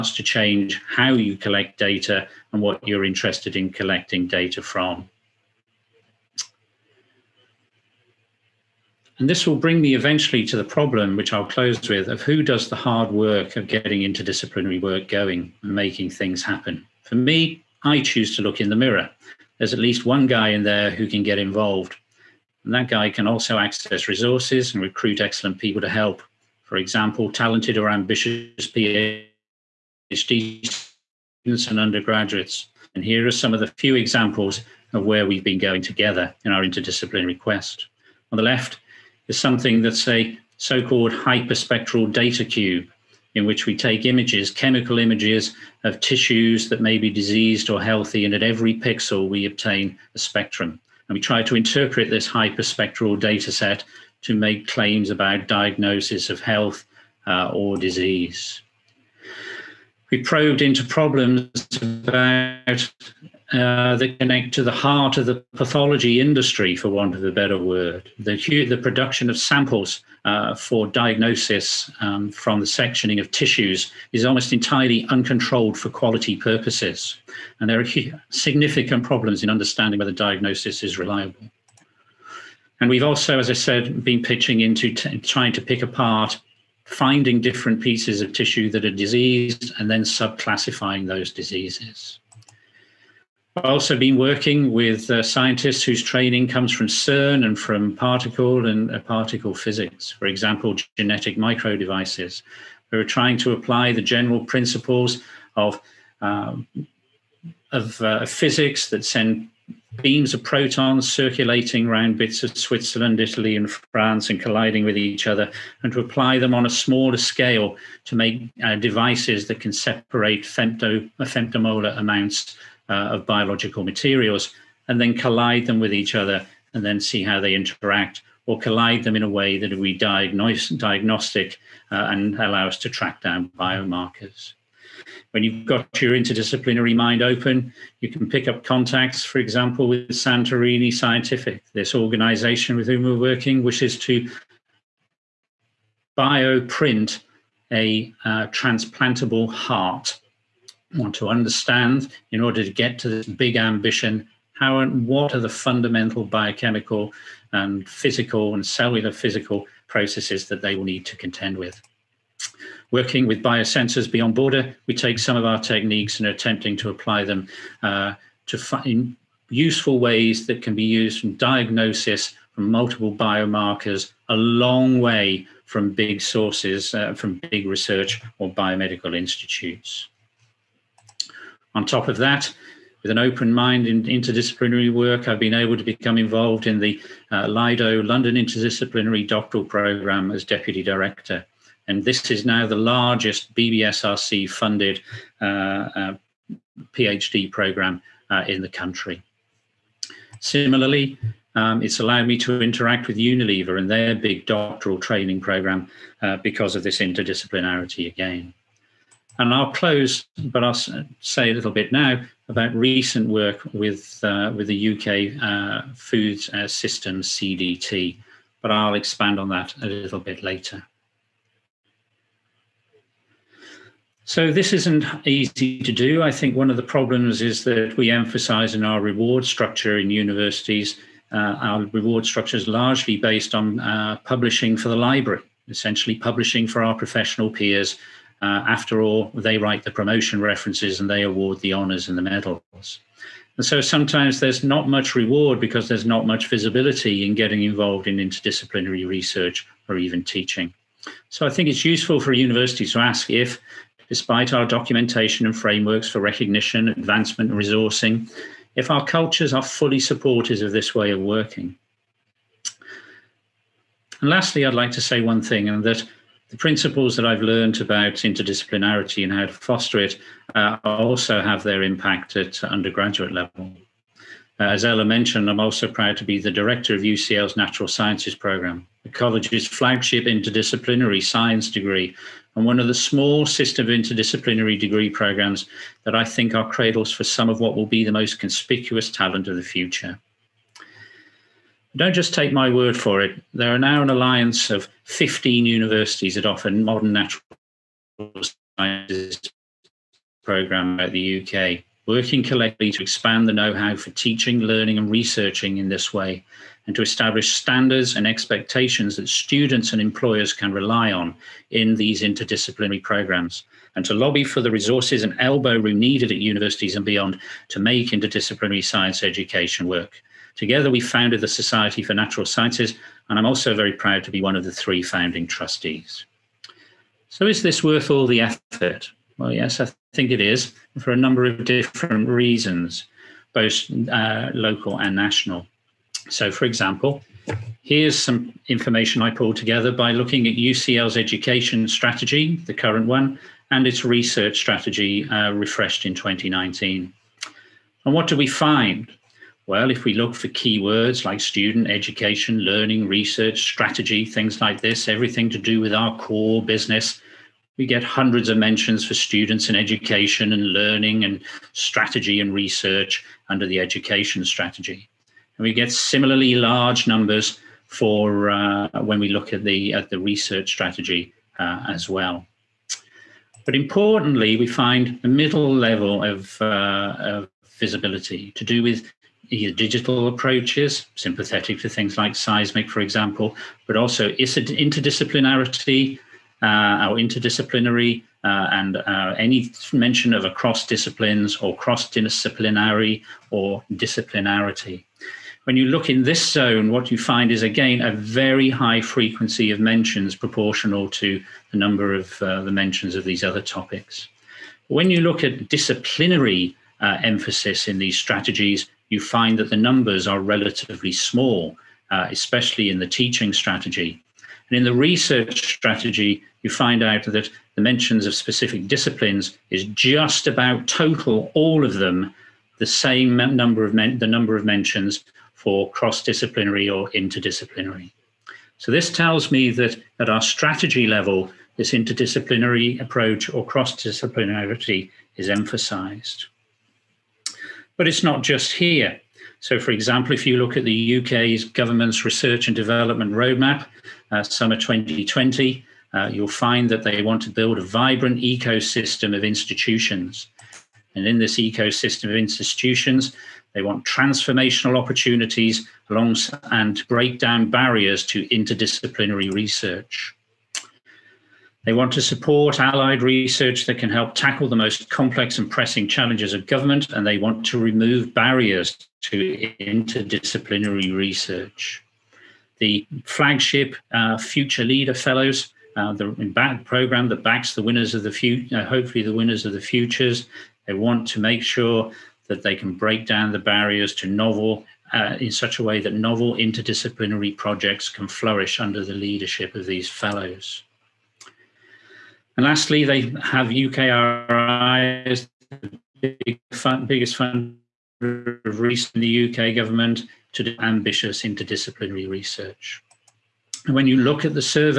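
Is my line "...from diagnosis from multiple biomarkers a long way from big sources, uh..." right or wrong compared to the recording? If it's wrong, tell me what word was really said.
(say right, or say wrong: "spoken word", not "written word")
right.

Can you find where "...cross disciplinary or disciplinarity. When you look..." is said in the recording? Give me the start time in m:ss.
6:31.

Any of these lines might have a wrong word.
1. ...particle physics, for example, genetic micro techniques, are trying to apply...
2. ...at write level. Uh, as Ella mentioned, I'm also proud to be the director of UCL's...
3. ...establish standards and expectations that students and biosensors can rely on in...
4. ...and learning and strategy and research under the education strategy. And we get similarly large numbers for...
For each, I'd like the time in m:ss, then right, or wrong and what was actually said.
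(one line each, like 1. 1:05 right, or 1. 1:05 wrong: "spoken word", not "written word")
1. 1:38 wrong: "devices", not "techniques"
2. 4:32 wrong: "undergraduate", not "write"
3. 5:07 wrong: "employers", not "biosensors"
4. 6:00 right.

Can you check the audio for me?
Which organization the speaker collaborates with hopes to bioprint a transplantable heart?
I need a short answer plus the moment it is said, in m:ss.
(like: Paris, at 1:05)
Santorini Scientific, at 2:20.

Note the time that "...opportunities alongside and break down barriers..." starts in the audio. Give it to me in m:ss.
7:34.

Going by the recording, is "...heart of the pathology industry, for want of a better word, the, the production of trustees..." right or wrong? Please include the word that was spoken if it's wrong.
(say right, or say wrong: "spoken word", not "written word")
wrong: "samples", not "trustees".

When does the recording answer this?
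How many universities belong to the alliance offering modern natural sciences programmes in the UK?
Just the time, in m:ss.
4:55.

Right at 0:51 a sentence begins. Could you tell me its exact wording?
And we try to interpret this hyperspectral data set to make claims about diagnosis of health uh, or disease.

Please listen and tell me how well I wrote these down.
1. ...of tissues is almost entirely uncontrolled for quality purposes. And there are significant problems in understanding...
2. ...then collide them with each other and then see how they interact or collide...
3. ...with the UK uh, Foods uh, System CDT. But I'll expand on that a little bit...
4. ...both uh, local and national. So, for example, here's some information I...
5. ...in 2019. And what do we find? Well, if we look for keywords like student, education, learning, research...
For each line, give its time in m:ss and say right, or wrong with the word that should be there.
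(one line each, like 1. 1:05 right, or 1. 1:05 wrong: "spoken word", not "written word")
1. 1:13 right
2. 2:04 right
3. 3:34 right
4. 5:33 right
5. 5:46 right.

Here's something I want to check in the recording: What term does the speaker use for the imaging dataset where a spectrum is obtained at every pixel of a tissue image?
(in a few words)
Hyperspectral data cube.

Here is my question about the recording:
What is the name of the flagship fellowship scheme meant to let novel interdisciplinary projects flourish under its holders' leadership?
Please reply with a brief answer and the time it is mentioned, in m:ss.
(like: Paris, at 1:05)
Future Leader Fellows, at 7:54.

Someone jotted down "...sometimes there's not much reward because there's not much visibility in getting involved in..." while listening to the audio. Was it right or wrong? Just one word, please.
right.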